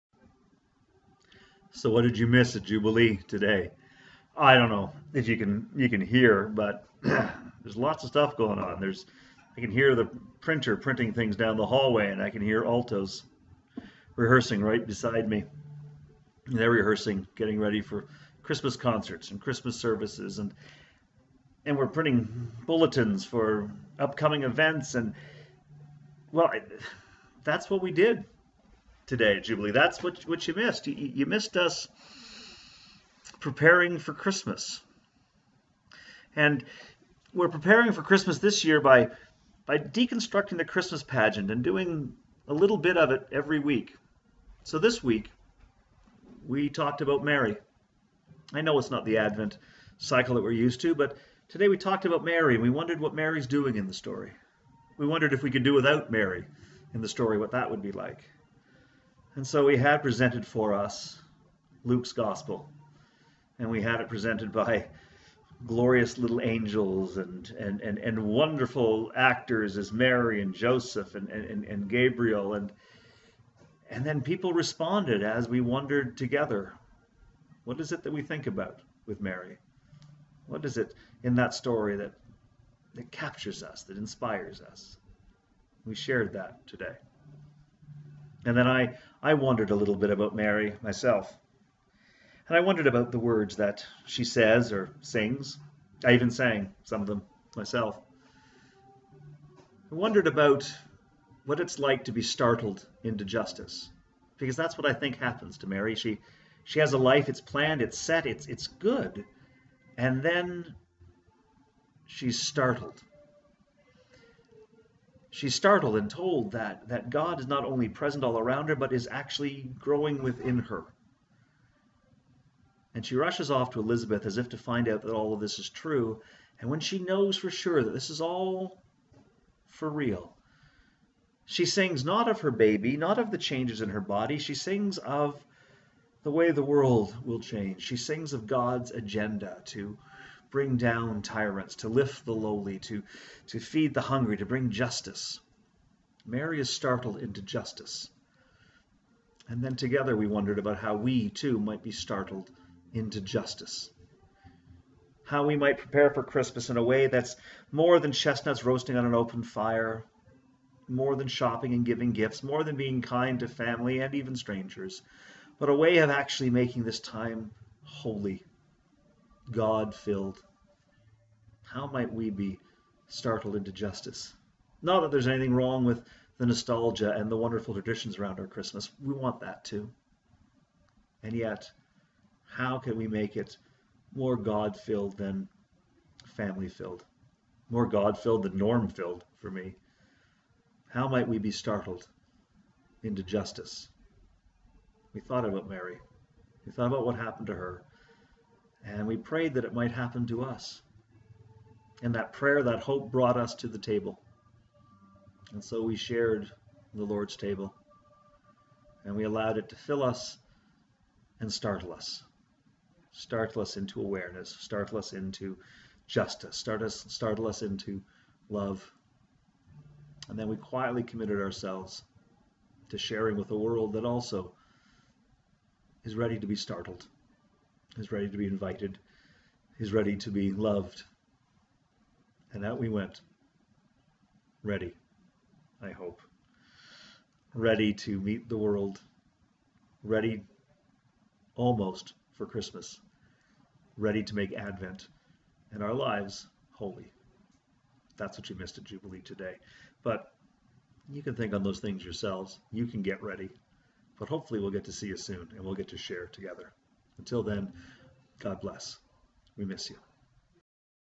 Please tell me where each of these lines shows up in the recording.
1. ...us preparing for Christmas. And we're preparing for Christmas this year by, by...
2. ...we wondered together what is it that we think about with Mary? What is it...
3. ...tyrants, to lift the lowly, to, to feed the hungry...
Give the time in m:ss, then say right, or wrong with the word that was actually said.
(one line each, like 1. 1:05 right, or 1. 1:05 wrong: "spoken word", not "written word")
1. 0:31 right
2. 1:15 right
3. 2:21 right.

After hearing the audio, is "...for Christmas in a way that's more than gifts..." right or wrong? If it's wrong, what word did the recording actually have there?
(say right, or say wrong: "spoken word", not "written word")
wrong: "chestnuts", not "gifts".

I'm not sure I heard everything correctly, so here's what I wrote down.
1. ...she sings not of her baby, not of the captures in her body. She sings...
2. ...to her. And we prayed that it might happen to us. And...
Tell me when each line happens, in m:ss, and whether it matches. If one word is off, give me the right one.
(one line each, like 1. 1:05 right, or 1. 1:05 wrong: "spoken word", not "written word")
1. 2:11 wrong: "changes", not "captures"
2. 3:17 right.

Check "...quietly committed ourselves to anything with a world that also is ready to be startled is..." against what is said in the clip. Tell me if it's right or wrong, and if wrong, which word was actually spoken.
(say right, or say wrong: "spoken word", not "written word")
wrong: "sharing", not "anything".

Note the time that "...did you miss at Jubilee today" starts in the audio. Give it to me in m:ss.
0:02.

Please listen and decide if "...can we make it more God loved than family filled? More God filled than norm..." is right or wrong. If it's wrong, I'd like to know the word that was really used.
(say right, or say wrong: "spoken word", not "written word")
wrong: "filled", not "loved".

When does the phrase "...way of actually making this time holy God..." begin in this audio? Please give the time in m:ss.
2:45.